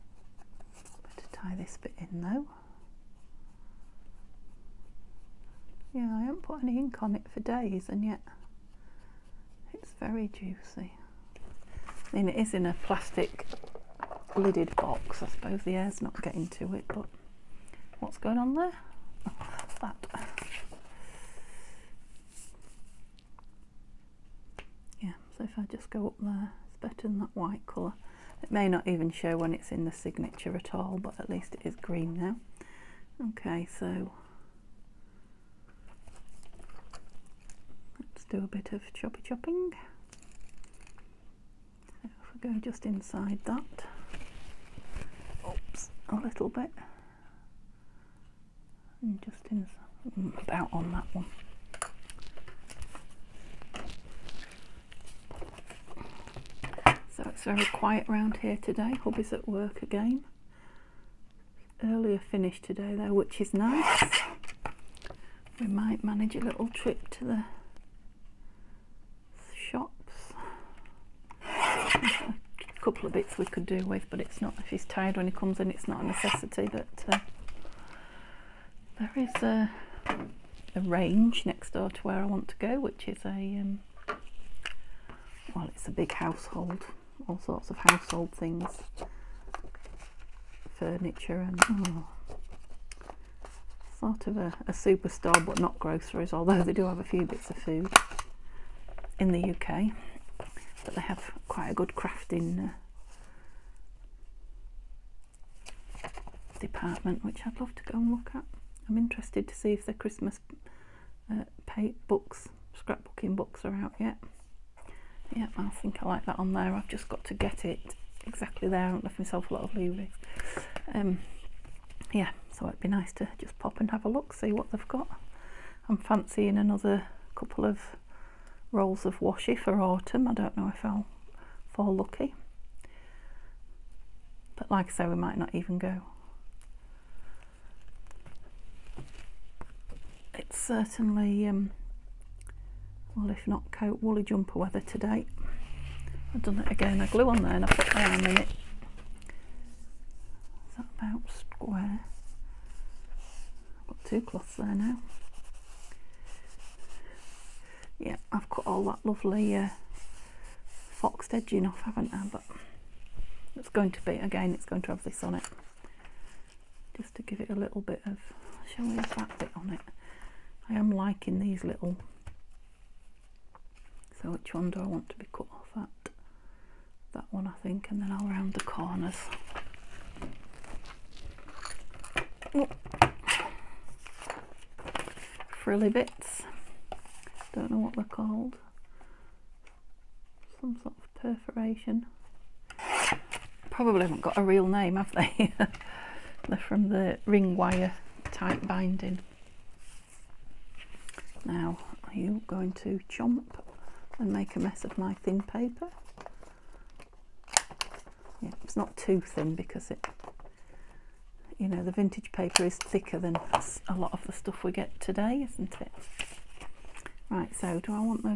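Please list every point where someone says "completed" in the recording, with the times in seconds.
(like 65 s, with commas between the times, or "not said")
not said.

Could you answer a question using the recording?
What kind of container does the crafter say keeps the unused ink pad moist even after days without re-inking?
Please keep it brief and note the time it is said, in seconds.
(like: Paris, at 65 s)
plastic lidded box, at 12 s.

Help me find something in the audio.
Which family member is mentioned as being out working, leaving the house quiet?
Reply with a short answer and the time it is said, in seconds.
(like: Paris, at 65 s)
Hubby, at 59 s.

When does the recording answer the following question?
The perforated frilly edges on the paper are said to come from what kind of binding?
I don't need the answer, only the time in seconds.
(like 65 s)
197 s.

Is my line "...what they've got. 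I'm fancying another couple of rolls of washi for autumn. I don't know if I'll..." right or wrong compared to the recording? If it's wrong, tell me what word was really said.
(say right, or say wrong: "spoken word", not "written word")
right.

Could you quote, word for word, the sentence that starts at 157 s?
Yeah, I've cut all that lovely uh, foxed edging off, haven't I?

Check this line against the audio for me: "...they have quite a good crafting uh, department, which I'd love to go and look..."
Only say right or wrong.
right.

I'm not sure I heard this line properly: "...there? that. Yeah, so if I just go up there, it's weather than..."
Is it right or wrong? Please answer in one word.
wrong.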